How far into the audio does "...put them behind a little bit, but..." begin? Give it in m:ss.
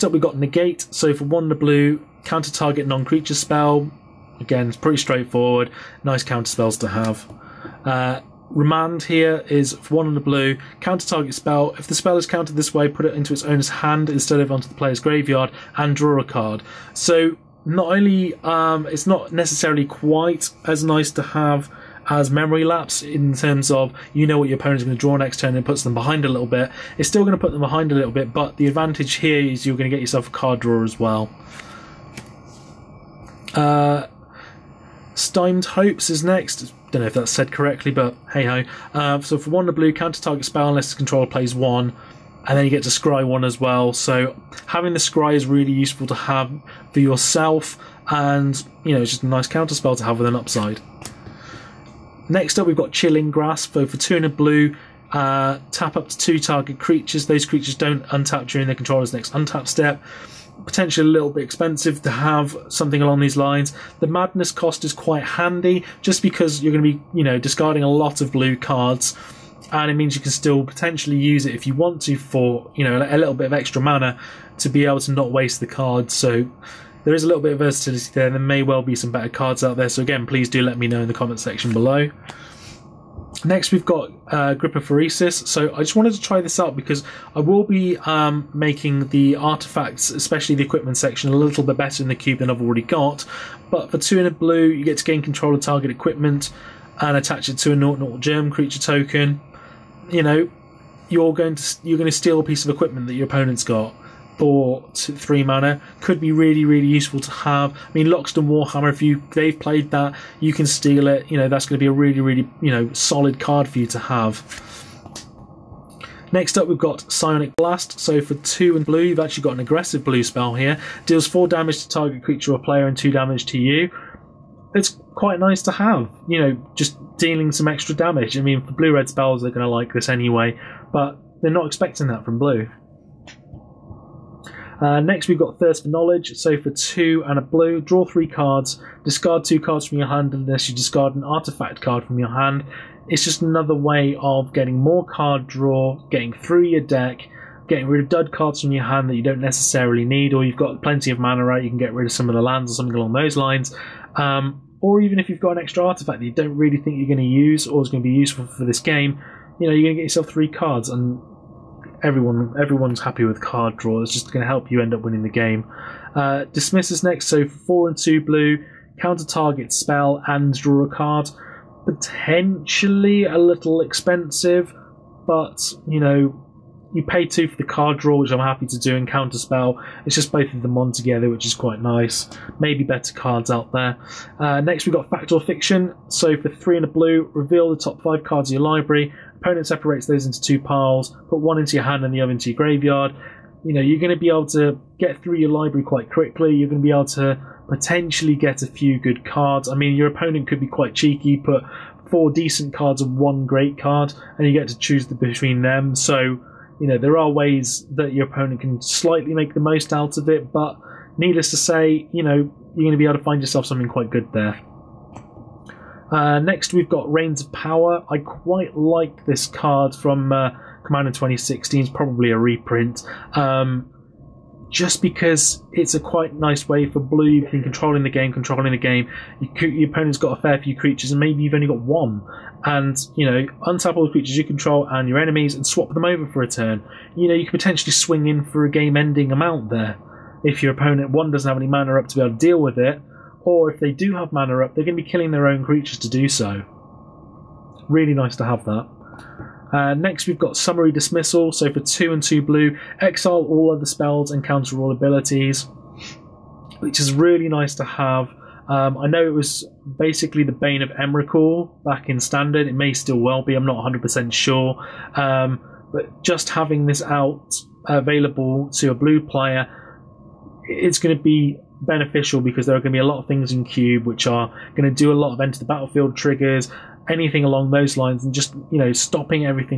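0:27.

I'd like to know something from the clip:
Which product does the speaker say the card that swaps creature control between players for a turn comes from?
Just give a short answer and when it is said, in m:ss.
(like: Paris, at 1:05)
Commander 2016, at 3:40.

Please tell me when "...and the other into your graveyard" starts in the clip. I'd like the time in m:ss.
3:12.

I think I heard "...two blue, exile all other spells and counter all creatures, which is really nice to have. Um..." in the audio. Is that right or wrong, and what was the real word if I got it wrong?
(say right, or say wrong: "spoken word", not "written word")
wrong: "abilities", not "creatures".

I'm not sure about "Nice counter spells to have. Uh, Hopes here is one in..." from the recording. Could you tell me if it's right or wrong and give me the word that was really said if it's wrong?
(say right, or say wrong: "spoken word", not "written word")
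wrong: "Remand", not "Hopes".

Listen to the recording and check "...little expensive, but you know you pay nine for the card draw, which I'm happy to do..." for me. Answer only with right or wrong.
wrong.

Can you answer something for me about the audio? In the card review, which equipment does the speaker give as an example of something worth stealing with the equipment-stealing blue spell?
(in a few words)
Loxodon Warhammer.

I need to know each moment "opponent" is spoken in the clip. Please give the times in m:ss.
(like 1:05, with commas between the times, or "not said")
0:24, 1:43, 3:09, 3:20, 3:28, 3:49, 4:00.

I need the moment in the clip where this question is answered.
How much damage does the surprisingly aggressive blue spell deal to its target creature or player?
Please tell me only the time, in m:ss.
2:01.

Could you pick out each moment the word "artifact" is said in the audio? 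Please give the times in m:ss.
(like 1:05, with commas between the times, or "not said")
1:29, 2:21, 2:35.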